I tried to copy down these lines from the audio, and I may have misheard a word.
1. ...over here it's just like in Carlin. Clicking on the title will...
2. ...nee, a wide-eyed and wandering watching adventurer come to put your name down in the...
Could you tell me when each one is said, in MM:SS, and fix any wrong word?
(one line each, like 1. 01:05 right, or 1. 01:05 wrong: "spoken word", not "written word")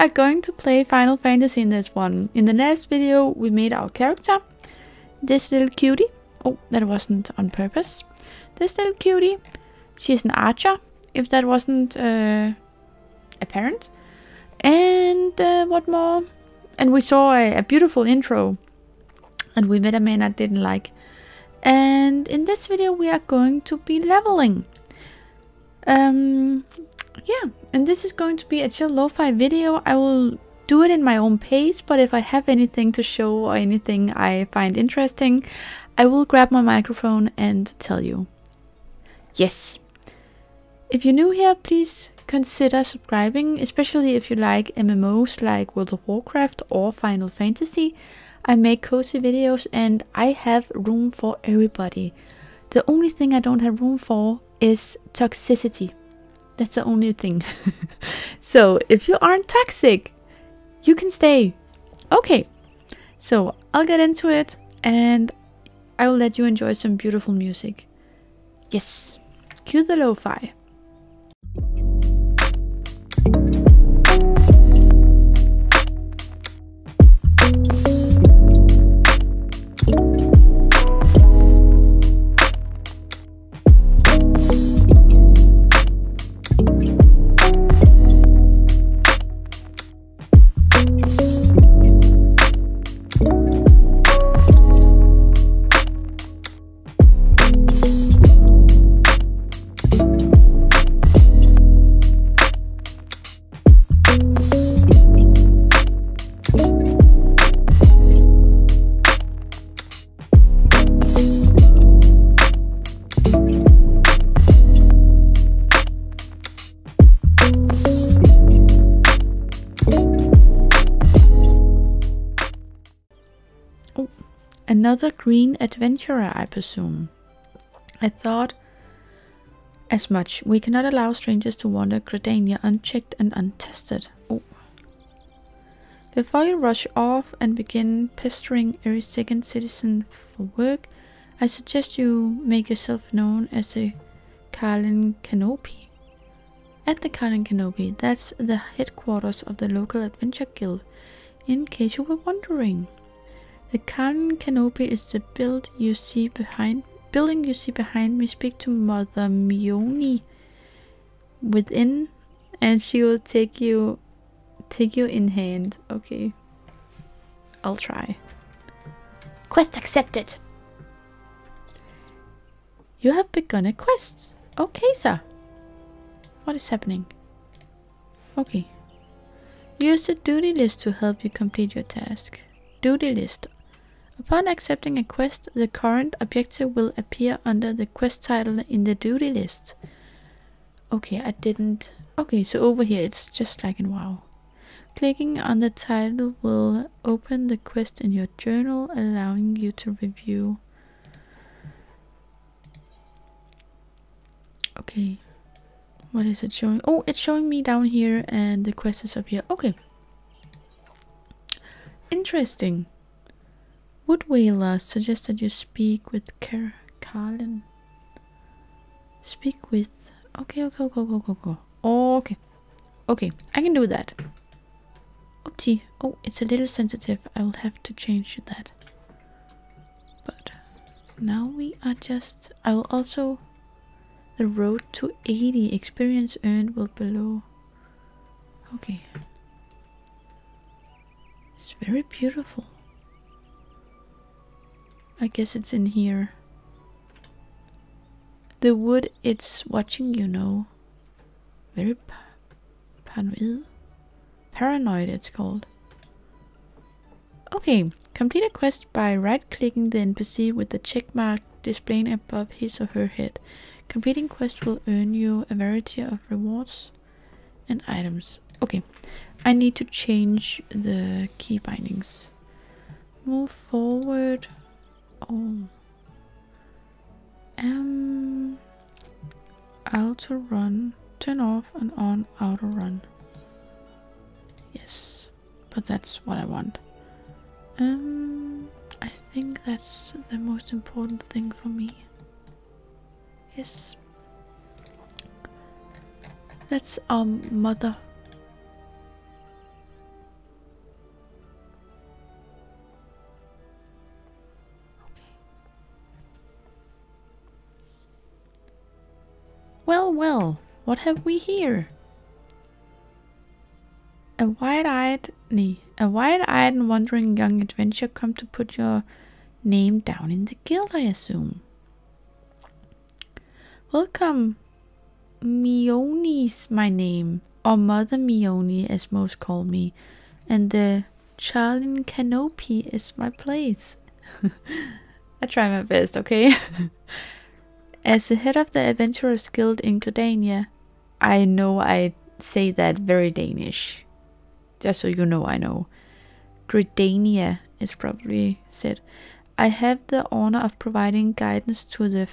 1. 03:12 wrong: "WoW", not "Carlin"
2. 05:15 wrong: "young", not "watching".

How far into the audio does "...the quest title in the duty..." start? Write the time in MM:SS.
03:07.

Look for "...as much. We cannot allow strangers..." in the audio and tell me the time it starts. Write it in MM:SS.
02:09.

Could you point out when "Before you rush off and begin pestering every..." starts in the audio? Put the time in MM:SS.
02:16.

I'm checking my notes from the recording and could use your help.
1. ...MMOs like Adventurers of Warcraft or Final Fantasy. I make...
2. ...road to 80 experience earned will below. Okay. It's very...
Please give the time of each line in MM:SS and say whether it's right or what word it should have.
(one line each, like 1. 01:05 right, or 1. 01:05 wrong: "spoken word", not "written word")
1. 00:44 wrong: "World", not "Adventurers"
2. 03:54 right.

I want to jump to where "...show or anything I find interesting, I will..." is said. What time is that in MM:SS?
00:33.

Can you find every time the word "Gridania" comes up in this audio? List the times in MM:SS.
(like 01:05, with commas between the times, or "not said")
05:40, 05:46.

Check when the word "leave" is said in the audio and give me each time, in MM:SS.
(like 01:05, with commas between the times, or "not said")
not said.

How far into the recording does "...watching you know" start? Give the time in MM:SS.
04:09.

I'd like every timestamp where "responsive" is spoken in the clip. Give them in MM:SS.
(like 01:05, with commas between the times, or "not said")
not said.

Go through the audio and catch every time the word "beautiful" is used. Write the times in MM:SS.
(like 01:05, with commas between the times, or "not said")
00:17, 01:06, 04:02.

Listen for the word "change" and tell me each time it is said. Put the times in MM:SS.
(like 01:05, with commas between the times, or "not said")
03:47, 04:29.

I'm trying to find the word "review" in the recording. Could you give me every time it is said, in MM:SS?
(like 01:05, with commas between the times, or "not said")
03:19.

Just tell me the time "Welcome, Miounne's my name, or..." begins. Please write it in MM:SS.
05:23.